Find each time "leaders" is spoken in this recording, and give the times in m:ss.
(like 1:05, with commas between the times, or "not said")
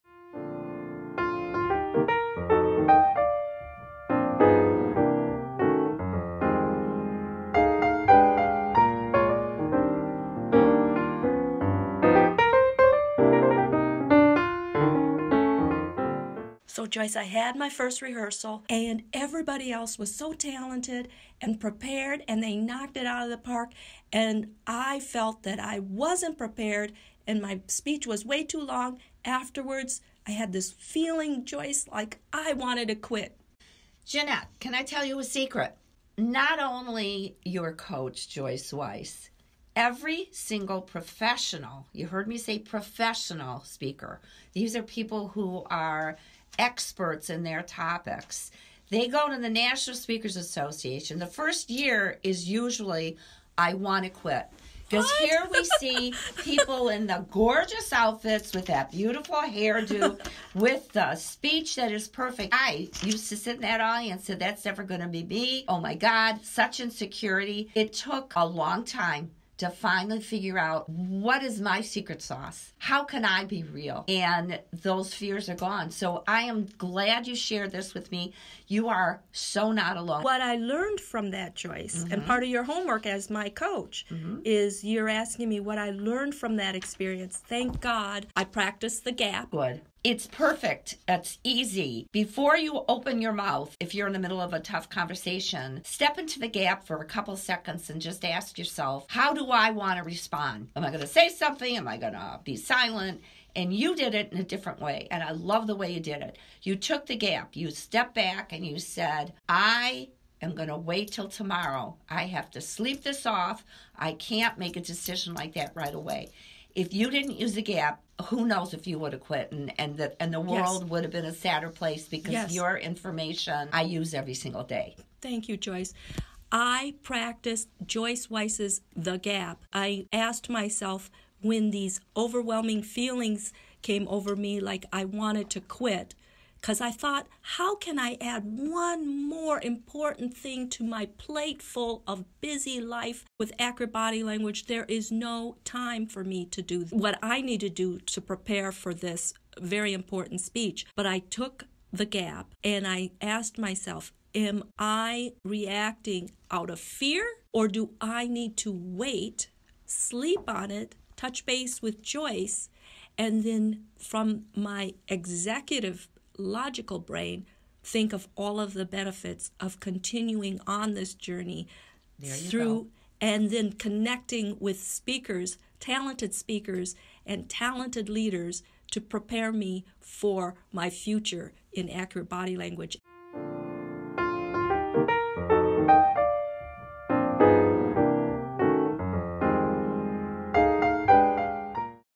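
2:58.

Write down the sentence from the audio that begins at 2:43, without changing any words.
And then from my executive logical brain think of all of the benefits of continuing on this journey through go.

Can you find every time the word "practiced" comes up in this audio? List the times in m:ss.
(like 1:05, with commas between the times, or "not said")
1:28, 2:07.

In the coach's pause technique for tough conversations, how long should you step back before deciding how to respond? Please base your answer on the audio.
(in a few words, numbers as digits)
A couple seconds.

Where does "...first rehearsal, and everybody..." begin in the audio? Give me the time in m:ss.
0:17.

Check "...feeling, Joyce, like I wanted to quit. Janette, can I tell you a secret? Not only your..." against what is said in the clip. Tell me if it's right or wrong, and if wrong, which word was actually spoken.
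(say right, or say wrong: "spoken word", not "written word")
right.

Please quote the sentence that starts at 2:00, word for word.
would have been a sadder place because yes.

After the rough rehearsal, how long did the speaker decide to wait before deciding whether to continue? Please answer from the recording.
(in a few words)
Tomorrow.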